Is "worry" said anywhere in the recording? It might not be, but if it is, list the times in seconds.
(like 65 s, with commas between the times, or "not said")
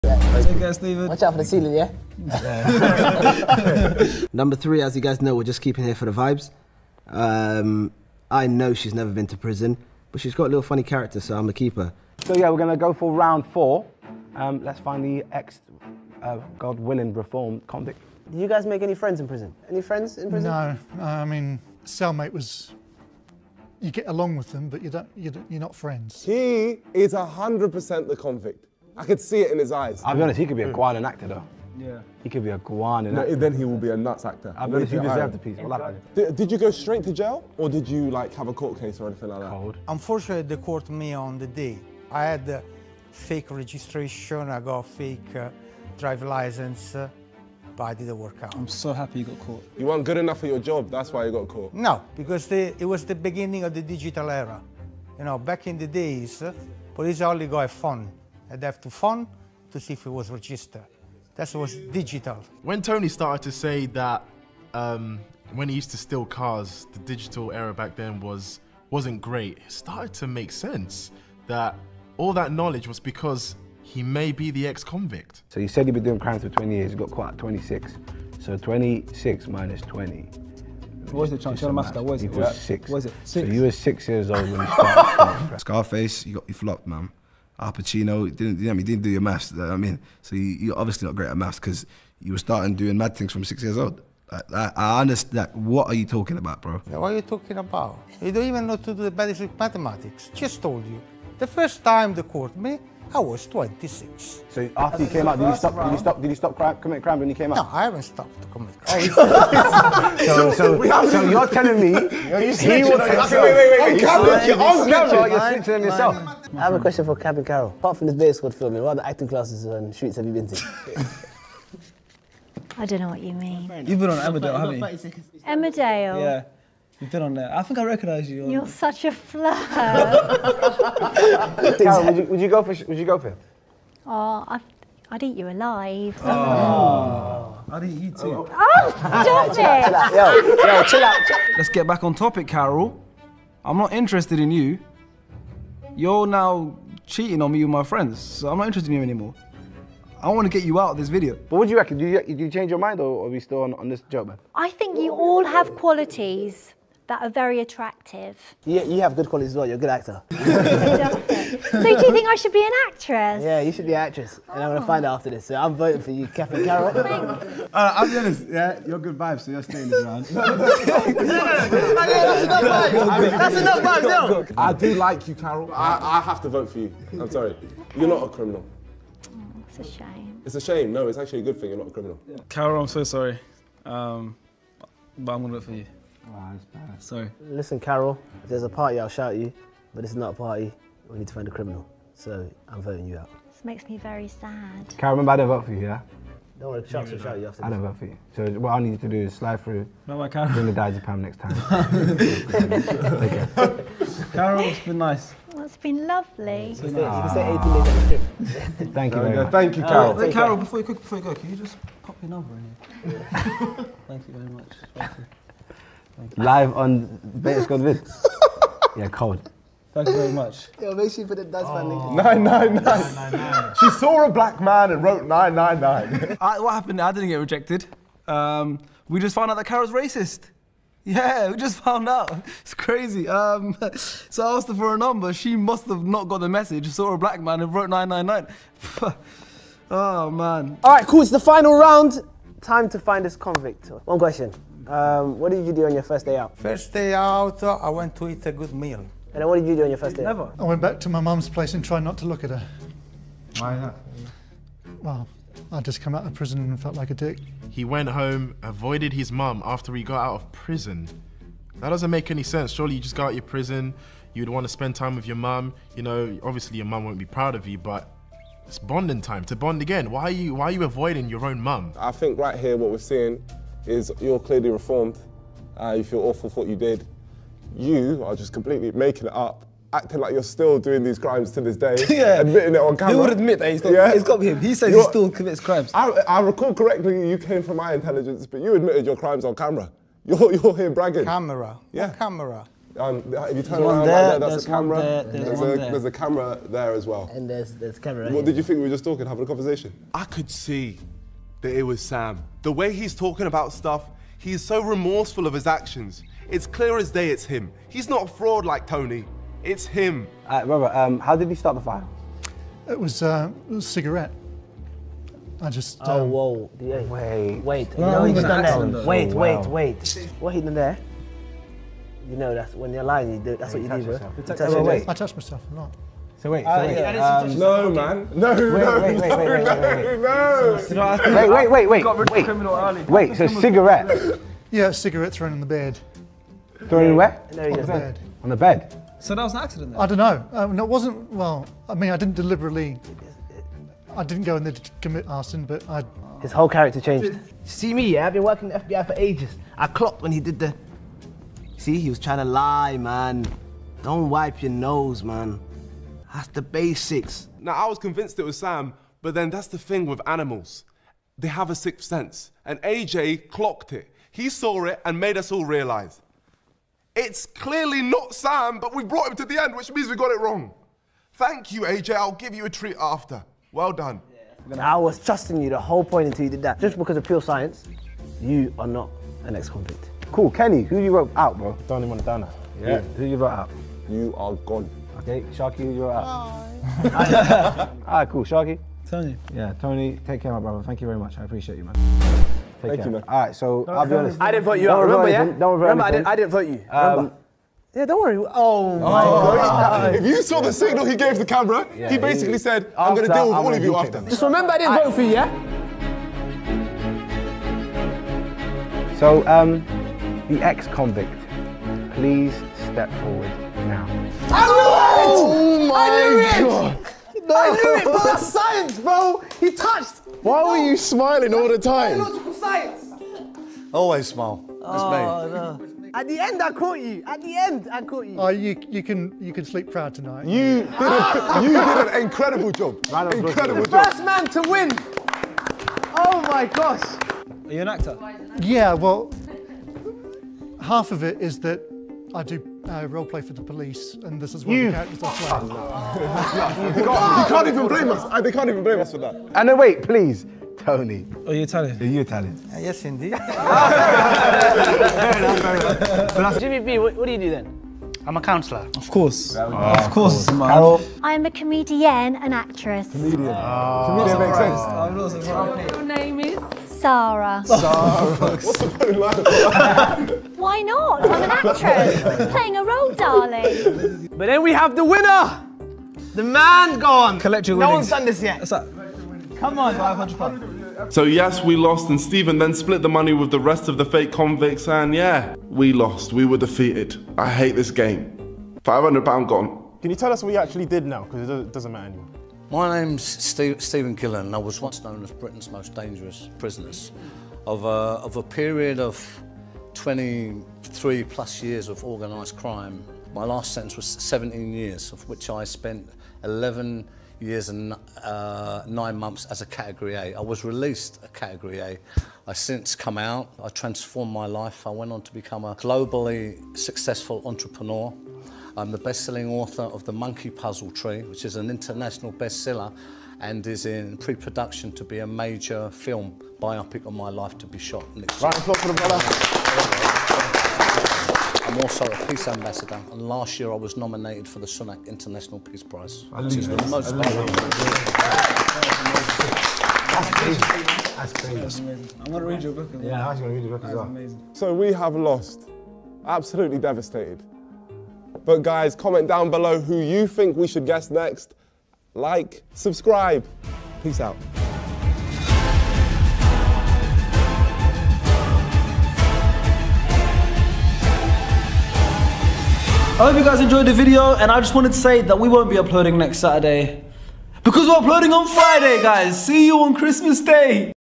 196 s, 398 s.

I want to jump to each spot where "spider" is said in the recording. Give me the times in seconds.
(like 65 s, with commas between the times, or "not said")
not said.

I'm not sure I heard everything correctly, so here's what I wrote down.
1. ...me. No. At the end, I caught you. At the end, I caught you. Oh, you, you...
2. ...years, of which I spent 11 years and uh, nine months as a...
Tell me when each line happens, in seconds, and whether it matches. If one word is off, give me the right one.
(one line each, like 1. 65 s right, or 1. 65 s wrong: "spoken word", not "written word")
1. 425 s right
2. 504 s right.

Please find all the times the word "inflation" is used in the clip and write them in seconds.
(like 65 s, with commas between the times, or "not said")
not said.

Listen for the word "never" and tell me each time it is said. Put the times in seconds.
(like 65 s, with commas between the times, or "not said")
8 s, 250 s.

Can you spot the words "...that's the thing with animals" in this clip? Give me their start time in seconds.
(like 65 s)
359 s.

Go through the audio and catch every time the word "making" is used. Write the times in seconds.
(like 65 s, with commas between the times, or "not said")
278 s.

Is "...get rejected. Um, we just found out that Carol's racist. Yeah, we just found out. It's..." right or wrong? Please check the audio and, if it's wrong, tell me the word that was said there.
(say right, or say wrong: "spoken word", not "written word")
right.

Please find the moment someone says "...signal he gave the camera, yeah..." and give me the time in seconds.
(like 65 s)
400 s.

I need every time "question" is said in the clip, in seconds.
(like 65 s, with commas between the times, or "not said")
116 s, 244 s.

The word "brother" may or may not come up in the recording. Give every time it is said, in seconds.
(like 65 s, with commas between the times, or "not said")
390 s, 528 s.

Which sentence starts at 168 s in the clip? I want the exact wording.
Yeah, you're good vibes, so you're staying this round.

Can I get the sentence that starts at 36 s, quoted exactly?
Did, did, you go straight to jail or did you like have a court case or anything like that?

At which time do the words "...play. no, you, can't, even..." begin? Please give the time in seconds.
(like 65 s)
445 s.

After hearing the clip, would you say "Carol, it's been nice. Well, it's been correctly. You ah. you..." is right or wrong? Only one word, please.
wrong.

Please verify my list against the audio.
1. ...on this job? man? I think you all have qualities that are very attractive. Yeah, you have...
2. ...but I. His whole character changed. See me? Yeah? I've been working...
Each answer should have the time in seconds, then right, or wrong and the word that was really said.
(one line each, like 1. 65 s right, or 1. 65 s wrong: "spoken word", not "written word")
1. 153 s right
2. 345 s right.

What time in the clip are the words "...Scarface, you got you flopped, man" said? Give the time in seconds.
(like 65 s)
85 s.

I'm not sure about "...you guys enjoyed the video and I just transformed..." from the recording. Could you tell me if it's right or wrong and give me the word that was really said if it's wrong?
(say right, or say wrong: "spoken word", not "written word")
wrong: "wanted", not "transformed".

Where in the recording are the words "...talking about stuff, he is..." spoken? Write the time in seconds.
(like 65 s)
303 s.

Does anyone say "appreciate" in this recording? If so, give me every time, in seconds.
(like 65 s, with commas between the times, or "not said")
391 s.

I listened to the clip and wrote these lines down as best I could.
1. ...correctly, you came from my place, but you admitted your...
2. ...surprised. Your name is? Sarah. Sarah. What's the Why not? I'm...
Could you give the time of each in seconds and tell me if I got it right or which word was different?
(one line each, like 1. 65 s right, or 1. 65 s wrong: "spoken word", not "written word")
1. 286 s wrong: "intelligence", not "place"
2. 465 s right.